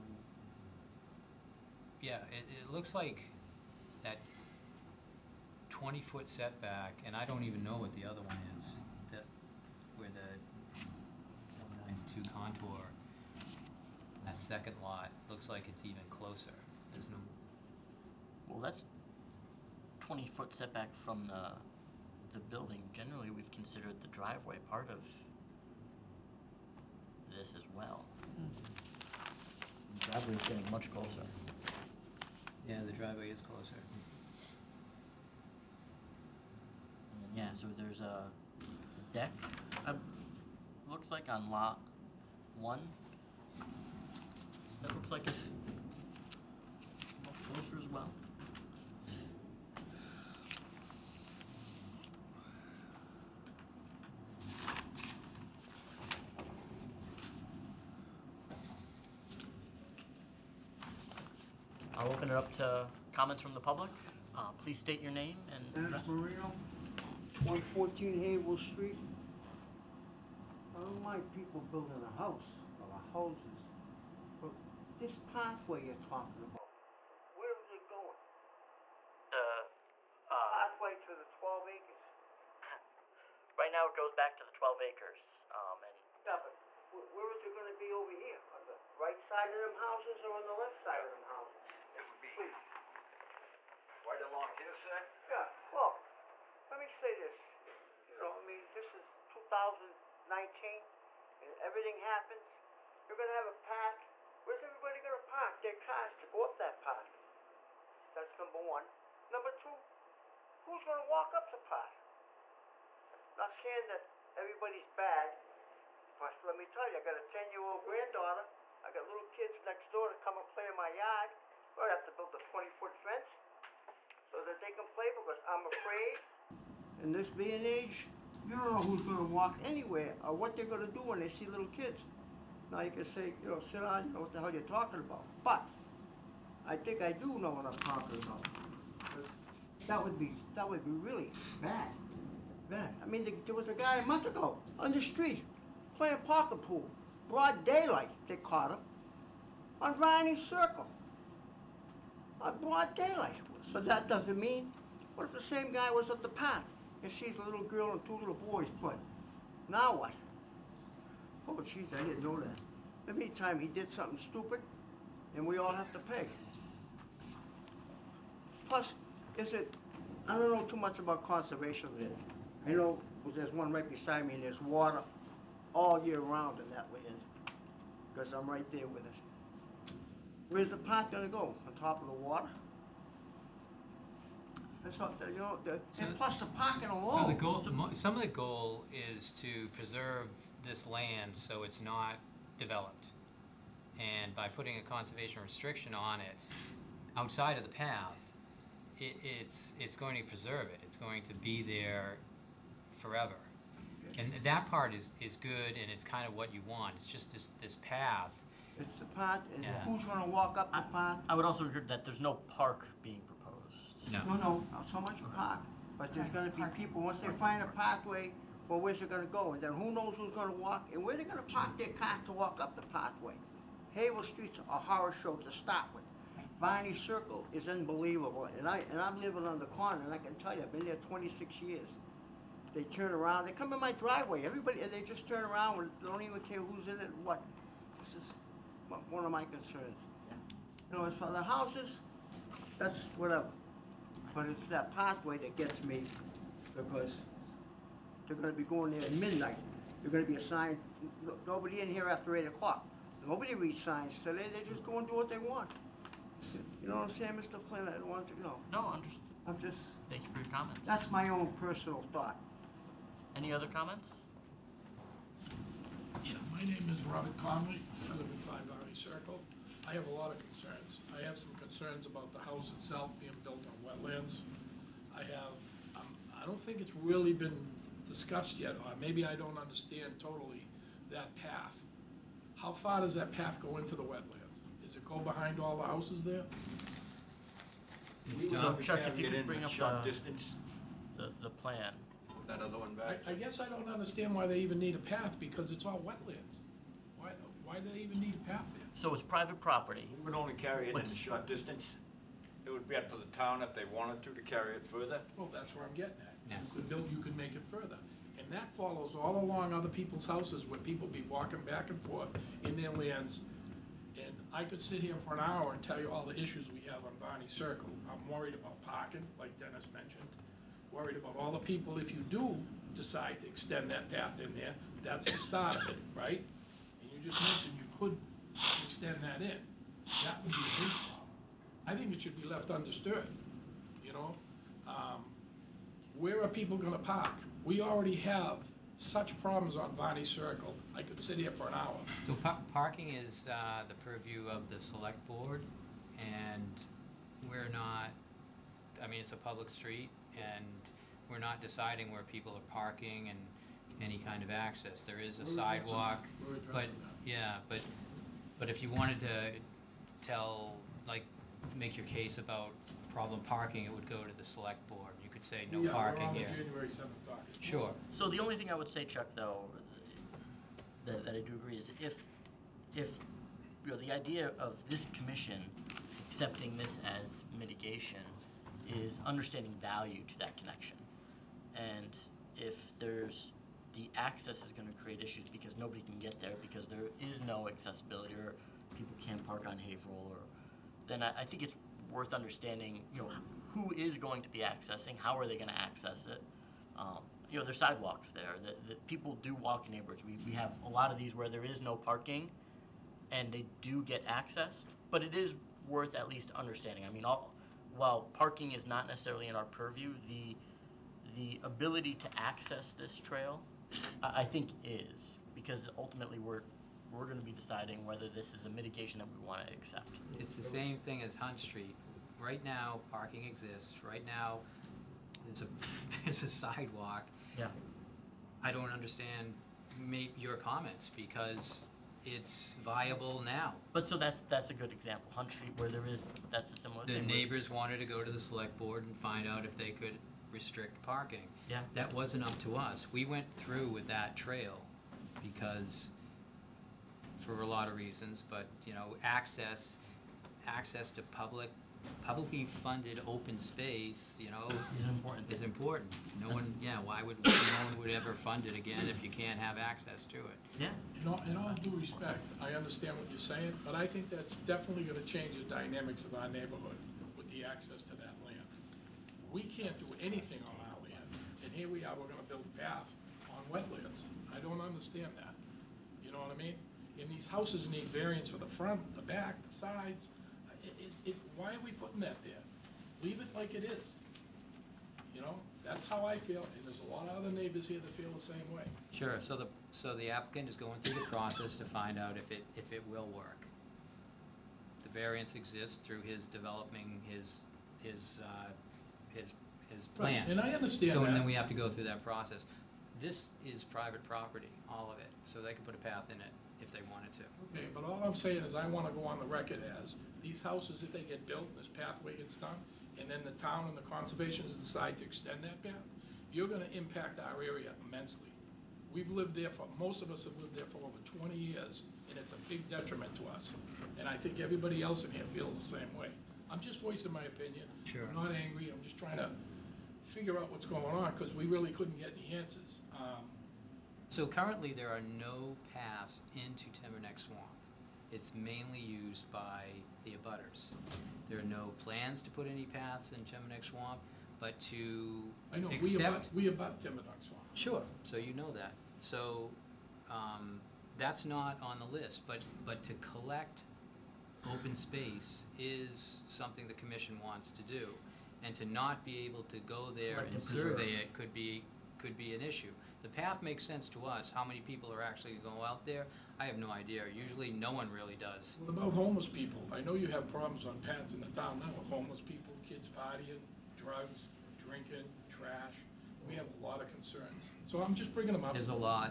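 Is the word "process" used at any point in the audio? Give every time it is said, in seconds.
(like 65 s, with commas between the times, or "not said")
491 s, 502 s.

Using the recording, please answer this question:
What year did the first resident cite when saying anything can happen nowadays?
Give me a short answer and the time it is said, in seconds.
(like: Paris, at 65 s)
2019, at 99 s.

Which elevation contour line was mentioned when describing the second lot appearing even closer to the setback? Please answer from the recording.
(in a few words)
92.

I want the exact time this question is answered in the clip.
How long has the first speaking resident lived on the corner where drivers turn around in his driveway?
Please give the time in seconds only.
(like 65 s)
231 s.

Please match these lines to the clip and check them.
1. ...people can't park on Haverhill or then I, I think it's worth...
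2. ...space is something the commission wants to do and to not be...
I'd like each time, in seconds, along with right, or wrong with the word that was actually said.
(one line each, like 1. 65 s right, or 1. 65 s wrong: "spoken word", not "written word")
1. 388 s right
2. 554 s right.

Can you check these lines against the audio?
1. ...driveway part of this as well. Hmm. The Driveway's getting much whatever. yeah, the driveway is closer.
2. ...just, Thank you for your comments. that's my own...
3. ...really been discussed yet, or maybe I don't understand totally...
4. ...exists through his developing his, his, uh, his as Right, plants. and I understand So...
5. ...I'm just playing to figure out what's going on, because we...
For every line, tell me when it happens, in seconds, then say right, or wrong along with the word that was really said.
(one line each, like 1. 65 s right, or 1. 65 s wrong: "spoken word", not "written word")
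1. 24 s wrong: "closer", not "whatever"
2. 259 s right
3. 276 s right
4. 495 s right
5. 528 s wrong: "trying", not "playing".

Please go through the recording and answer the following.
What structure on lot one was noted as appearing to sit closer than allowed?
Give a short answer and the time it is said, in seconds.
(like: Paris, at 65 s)
A deck, at 39 s.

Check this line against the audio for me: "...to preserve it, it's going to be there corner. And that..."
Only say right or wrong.
wrong.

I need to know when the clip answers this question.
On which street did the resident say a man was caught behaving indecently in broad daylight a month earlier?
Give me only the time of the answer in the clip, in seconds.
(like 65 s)
149 s.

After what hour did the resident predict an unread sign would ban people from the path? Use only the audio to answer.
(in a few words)
8 o'clock.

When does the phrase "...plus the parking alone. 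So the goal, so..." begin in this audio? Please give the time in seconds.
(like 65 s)
186 s.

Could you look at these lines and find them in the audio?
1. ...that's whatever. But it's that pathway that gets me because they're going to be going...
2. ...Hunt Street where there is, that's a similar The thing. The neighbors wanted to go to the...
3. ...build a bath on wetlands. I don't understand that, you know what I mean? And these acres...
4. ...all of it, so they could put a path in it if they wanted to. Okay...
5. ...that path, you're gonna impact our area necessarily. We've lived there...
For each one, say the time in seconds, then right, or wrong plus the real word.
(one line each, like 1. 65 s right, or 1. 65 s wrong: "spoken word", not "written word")
1. 242 s right
2. 435 s right
3. 472 s wrong: "houses", not "acres"
4. 504 s right
5. 515 s wrong: "immensely", not "necessarily".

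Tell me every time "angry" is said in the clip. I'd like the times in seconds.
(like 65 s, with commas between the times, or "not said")
528 s.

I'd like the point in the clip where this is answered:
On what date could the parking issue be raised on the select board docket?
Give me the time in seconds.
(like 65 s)
366 s.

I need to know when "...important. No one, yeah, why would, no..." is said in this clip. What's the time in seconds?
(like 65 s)
455 s.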